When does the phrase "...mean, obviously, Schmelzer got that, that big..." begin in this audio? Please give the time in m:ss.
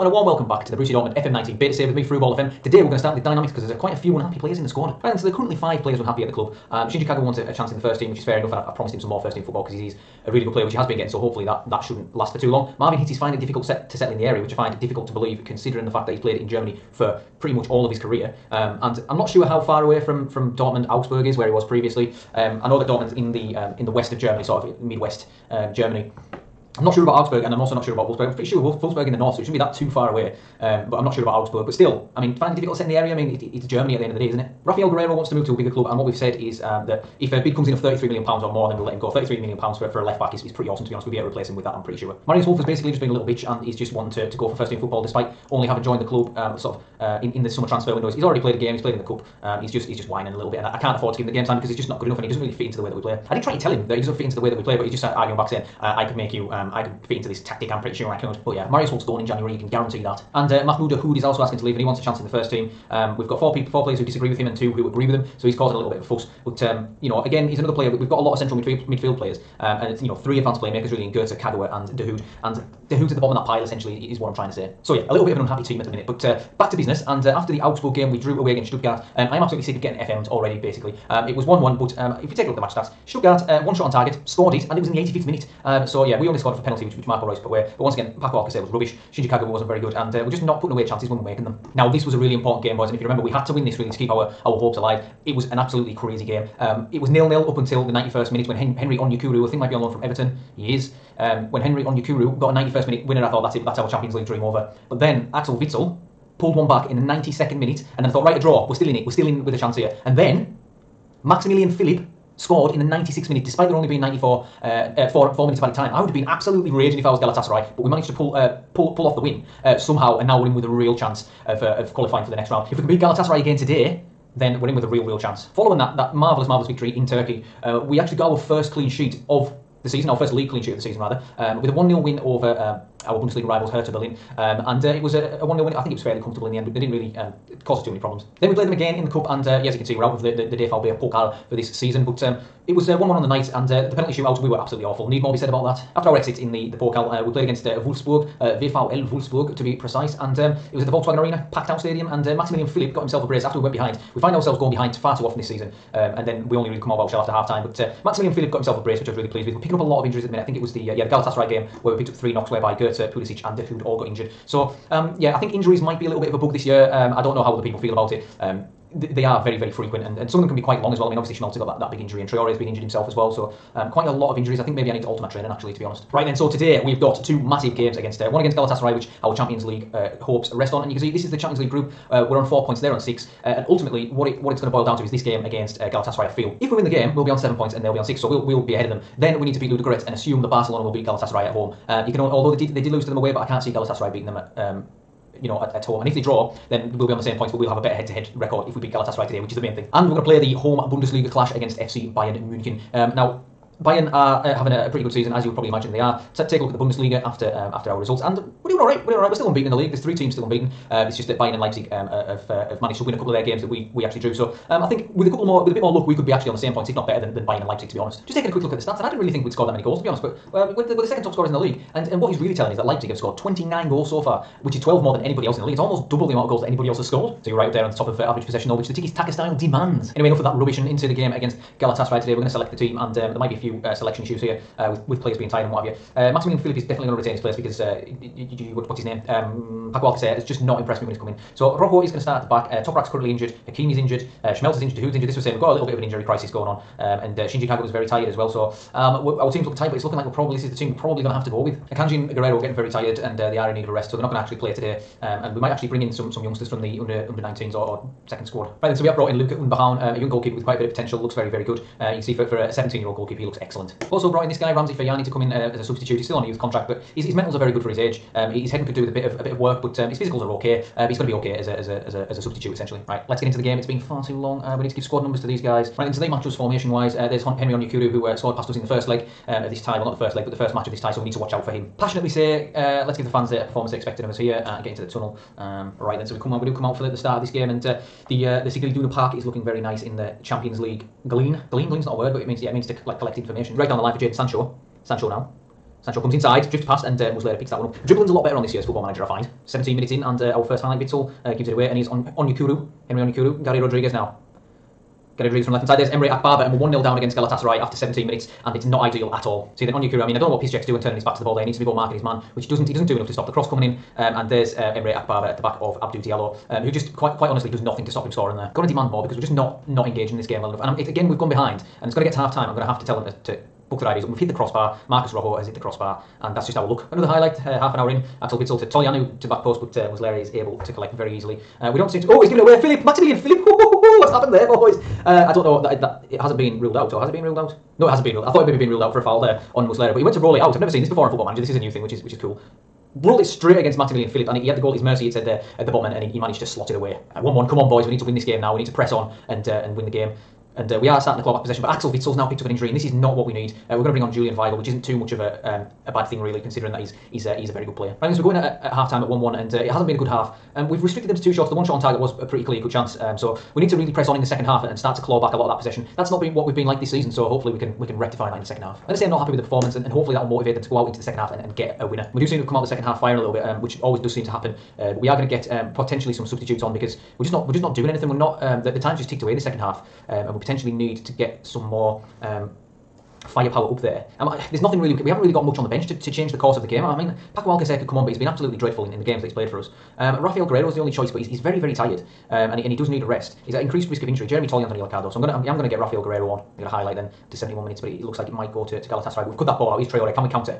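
2:51.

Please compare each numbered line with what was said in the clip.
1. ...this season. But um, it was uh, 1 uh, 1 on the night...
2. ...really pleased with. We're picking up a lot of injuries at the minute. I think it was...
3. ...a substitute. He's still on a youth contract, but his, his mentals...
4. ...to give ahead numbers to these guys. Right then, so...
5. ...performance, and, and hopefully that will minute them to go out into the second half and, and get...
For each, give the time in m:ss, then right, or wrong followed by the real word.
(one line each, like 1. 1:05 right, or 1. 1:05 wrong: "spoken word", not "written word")
1. 2:21 right
2. 2:39 right
3. 4:25 right
4. 4:34 wrong: "squad", not "ahead"
5. 6:09 wrong: "motivate", not "minute".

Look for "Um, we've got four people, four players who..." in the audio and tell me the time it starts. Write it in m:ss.
1:02.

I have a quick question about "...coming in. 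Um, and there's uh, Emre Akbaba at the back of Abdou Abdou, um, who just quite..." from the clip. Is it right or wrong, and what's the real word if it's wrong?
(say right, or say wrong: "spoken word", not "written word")
wrong: "Diallo", not "Abdou".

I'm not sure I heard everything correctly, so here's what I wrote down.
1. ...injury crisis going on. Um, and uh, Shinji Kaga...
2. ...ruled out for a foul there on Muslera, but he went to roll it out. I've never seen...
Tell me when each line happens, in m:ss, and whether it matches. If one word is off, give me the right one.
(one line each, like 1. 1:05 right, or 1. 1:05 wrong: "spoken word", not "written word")
1. 4:06 right
2. 5:38 right.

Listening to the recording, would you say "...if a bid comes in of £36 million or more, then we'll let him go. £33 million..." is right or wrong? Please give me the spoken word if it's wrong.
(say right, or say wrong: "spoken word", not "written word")
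wrong: "33", not "36".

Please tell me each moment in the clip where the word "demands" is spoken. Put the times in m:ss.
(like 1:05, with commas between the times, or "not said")
3:49, 5:18.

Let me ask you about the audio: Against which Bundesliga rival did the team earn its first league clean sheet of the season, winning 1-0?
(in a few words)
Hertha Berlin.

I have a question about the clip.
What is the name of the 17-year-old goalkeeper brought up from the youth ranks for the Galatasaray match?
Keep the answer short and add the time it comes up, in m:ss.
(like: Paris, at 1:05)
Luca Unbehaun, at 4:19.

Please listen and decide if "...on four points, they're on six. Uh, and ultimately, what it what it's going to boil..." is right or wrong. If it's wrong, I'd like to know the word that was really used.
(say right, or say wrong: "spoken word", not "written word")
right.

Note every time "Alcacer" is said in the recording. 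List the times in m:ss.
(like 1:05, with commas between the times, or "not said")
1:28, 4:00, 6:27.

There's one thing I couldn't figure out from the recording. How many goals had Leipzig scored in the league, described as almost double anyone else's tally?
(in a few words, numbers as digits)
29.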